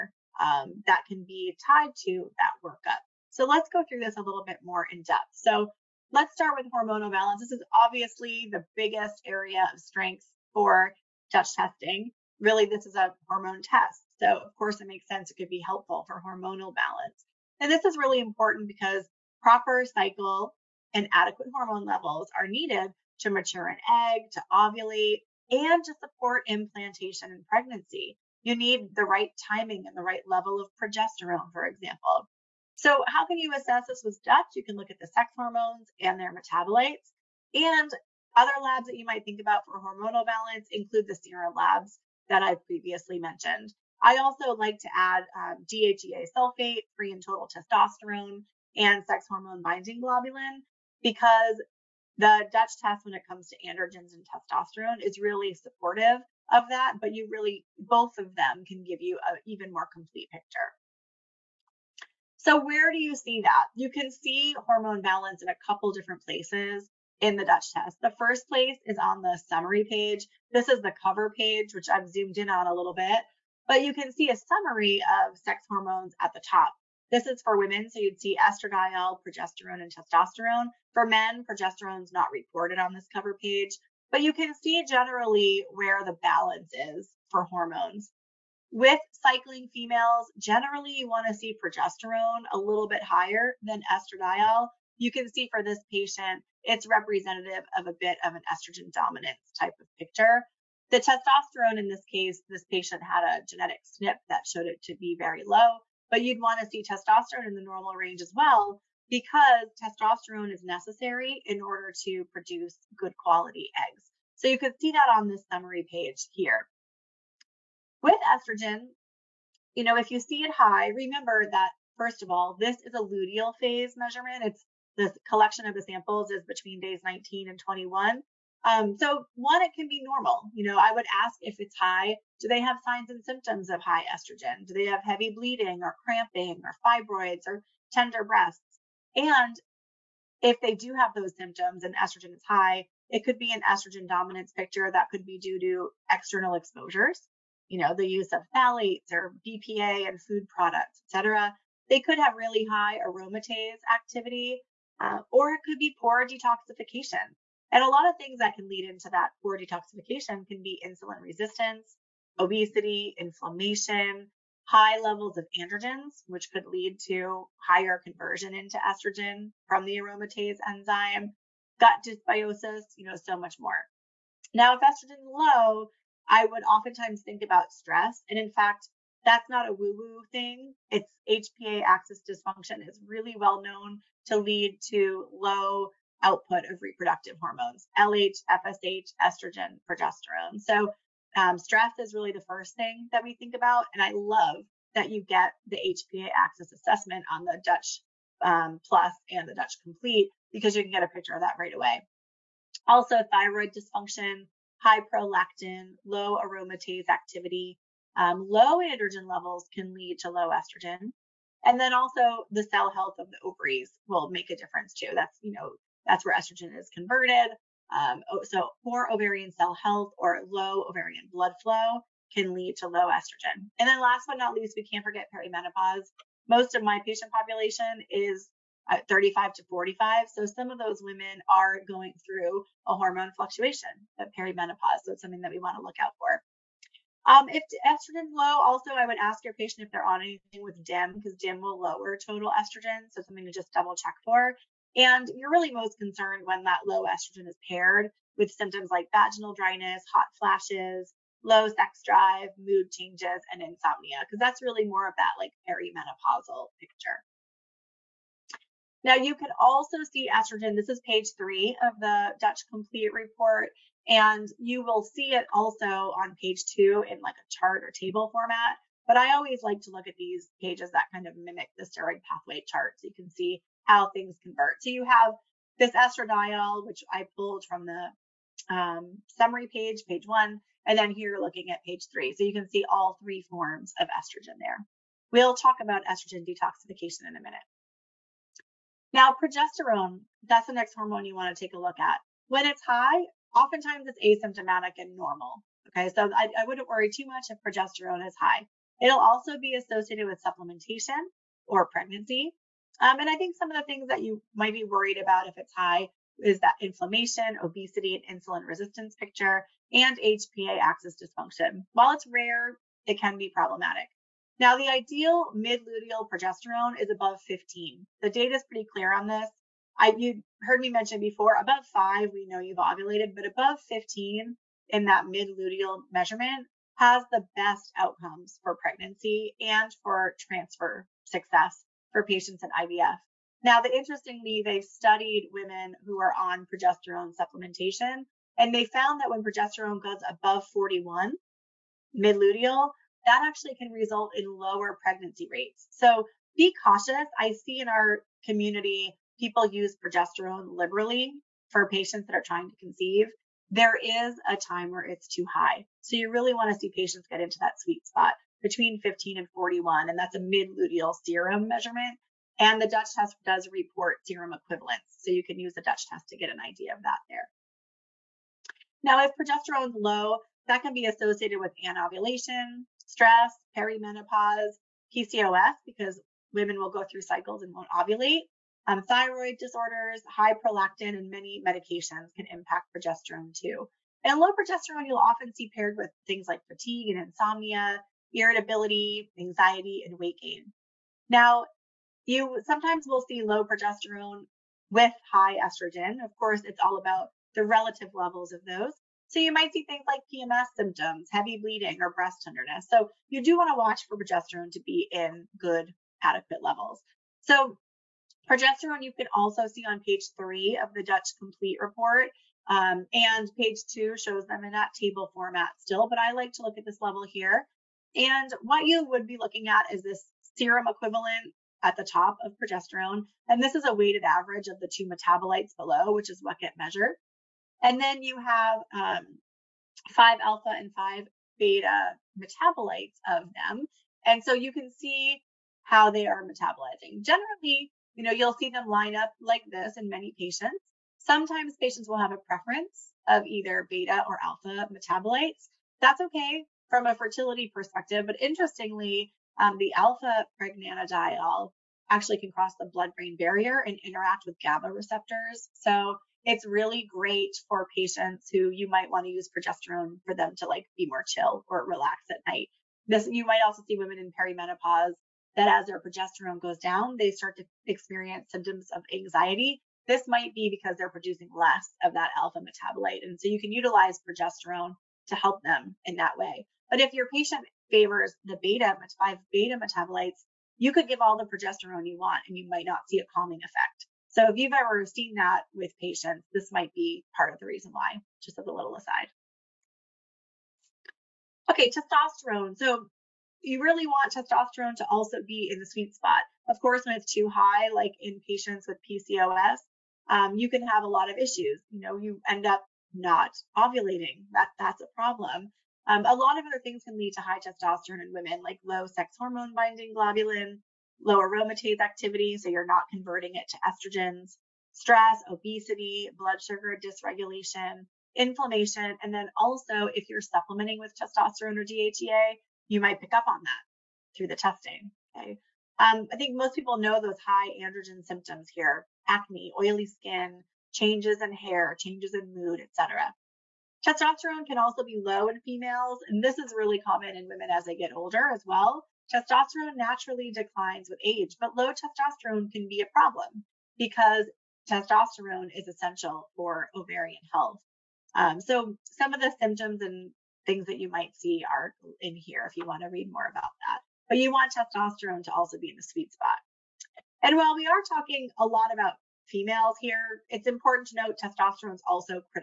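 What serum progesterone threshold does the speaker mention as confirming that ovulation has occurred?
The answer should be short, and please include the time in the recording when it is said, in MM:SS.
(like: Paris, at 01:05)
above 5, at 05:21.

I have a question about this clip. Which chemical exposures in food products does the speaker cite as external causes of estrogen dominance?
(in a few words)
phthalates or BPA.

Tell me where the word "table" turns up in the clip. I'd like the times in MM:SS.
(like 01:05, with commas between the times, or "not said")
04:27, 06:54.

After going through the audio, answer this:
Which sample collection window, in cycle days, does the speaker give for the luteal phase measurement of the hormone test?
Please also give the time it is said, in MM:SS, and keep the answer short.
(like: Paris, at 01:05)
days 19 and 21, at 02:06.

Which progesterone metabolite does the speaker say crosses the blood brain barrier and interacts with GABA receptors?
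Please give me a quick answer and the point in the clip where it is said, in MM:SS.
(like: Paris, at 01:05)
alpha pregnanediol, at 07:29.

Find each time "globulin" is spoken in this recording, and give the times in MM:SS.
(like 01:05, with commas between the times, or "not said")
00:50, 08:30.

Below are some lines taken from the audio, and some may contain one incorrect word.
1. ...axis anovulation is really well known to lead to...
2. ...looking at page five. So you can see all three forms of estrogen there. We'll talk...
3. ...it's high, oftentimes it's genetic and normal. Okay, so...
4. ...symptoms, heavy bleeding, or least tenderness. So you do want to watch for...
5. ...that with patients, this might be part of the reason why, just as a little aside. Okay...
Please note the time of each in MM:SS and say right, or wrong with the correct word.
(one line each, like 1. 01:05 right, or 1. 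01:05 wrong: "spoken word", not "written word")
1. 03:01 wrong: "dysfunction", not "anovulation"
2. 04:41 wrong: "three", not "five"
3. 04:52 wrong: "asymptomatic", not "genetic"
4. 06:40 wrong: "breast", not "least"
5. 08:05 right.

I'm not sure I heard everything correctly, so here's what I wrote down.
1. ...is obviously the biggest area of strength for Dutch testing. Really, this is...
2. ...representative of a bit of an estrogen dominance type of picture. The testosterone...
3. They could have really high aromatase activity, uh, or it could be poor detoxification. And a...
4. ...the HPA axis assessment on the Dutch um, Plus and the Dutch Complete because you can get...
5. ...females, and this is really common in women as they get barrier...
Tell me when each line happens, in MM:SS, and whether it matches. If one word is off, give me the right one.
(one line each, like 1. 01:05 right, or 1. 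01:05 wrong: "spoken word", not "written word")
1. 00:07 right
2. 01:36 right
3. 02:31 right
4. 03:15 right
5. 08:55 wrong: "older", not "barrier".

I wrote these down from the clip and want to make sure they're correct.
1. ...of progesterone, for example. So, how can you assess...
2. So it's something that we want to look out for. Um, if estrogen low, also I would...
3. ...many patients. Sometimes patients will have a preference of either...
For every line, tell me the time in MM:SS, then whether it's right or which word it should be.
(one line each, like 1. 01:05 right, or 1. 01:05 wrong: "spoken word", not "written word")
1. 00:30 right
2. 03:55 right
3. 07:20 right.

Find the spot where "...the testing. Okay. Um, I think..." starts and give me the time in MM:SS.
08:44.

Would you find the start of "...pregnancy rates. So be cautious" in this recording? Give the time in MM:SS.
05:45.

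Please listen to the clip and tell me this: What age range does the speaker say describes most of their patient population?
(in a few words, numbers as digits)
35 to 45.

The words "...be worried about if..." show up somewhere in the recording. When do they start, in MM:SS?
05:04.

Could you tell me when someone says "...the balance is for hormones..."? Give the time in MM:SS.
01:26.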